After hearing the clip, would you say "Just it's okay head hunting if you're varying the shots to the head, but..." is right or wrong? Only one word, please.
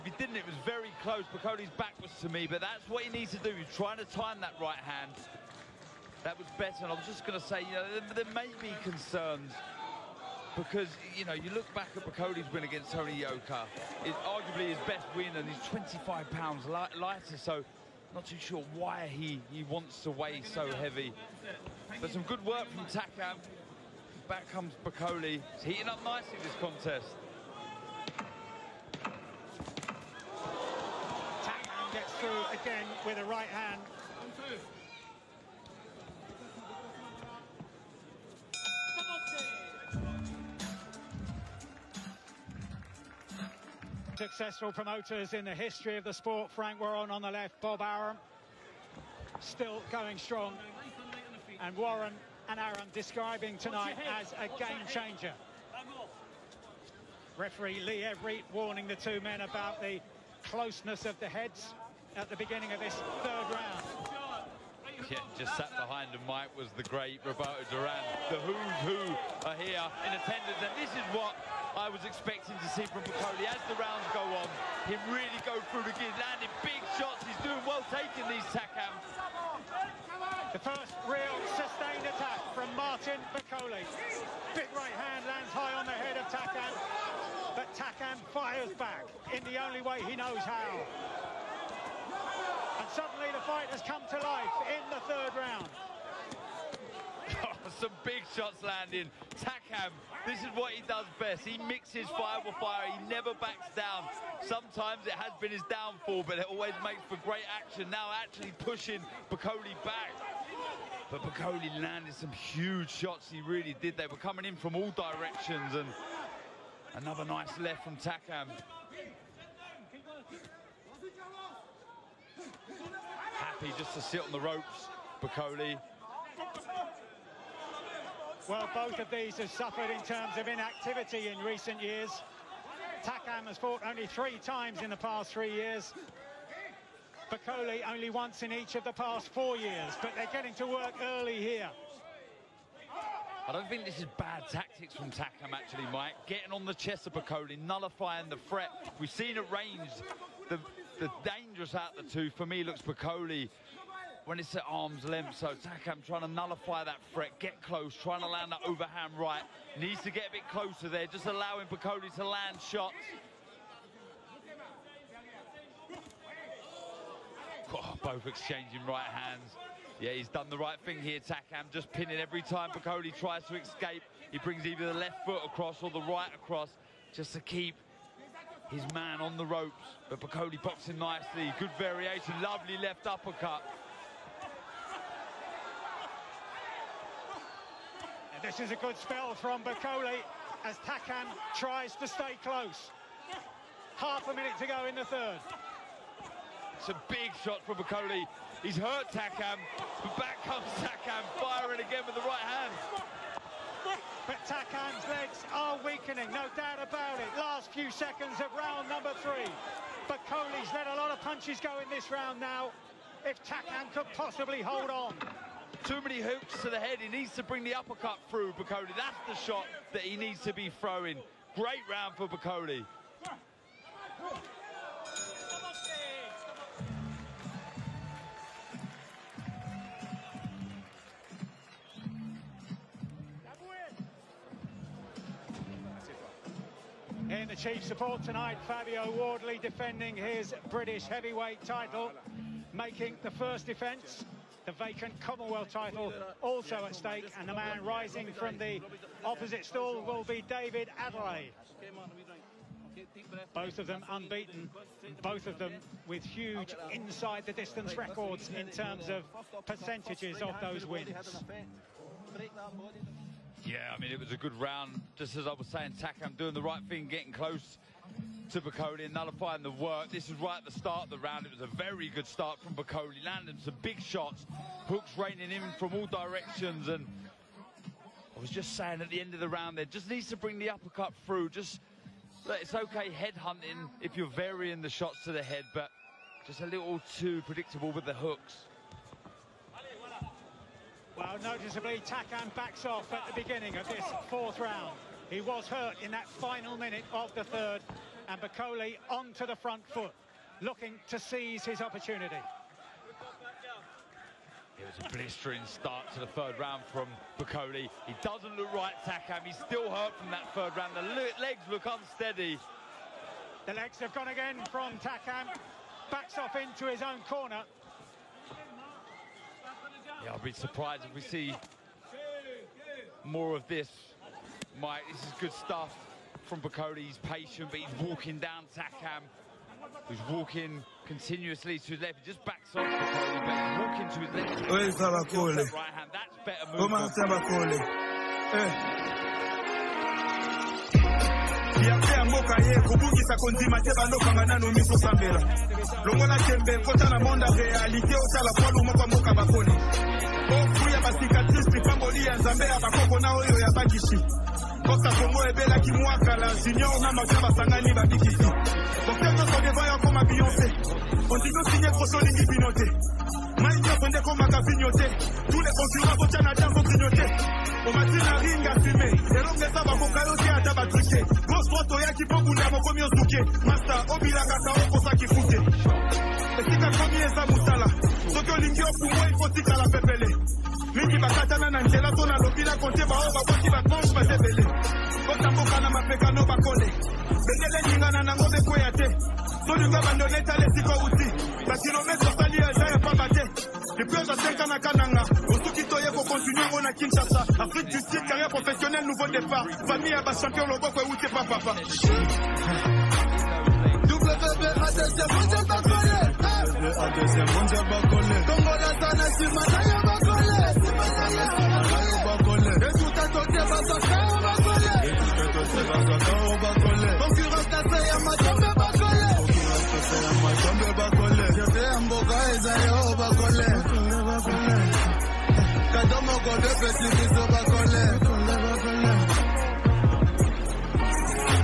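right.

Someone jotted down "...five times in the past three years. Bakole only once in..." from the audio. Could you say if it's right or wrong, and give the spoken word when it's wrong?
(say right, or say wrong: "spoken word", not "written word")
wrong: "three", not "five".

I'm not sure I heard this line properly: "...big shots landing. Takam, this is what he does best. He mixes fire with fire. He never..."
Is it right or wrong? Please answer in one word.
right.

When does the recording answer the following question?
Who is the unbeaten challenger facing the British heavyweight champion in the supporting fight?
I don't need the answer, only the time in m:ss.
4:10.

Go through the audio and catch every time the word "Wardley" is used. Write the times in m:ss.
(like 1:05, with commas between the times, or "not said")
3:59.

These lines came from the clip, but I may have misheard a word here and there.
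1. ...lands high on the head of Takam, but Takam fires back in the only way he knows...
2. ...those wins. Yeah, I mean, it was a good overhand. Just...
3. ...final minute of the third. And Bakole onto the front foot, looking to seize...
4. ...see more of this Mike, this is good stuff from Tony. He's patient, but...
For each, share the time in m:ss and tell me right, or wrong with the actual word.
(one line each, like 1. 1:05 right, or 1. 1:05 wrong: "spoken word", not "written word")
1. 1:25 right
2. 4:20 wrong: "round", not "overhand"
3. 4:56 right
4. 5:21 wrong: "Bakole", not "Tony".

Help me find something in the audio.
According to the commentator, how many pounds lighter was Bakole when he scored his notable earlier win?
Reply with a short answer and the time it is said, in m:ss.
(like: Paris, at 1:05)
25, at 0:15.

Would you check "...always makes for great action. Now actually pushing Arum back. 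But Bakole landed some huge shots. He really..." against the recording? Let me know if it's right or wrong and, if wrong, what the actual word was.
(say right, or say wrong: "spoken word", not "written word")
wrong: "Bakole", not "Arum".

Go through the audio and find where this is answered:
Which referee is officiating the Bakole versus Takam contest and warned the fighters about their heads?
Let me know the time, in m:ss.
0:57.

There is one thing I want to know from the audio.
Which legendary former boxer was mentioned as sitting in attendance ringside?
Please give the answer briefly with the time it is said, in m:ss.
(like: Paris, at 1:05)
Roberto Duran, at 1:07.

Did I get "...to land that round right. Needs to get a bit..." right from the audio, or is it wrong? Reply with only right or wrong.
wrong.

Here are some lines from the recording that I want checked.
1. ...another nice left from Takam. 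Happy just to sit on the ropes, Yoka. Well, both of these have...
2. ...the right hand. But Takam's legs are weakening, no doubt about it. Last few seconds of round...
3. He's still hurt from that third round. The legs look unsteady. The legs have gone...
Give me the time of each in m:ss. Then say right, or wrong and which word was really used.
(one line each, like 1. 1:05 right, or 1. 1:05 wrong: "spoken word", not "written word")
1. 1:57 wrong: "Bakole", not "Yoka"
2. 3:22 right
3. 5:09 right.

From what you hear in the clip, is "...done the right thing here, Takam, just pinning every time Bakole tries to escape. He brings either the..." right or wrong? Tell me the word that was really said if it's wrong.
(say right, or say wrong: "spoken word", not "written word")
right.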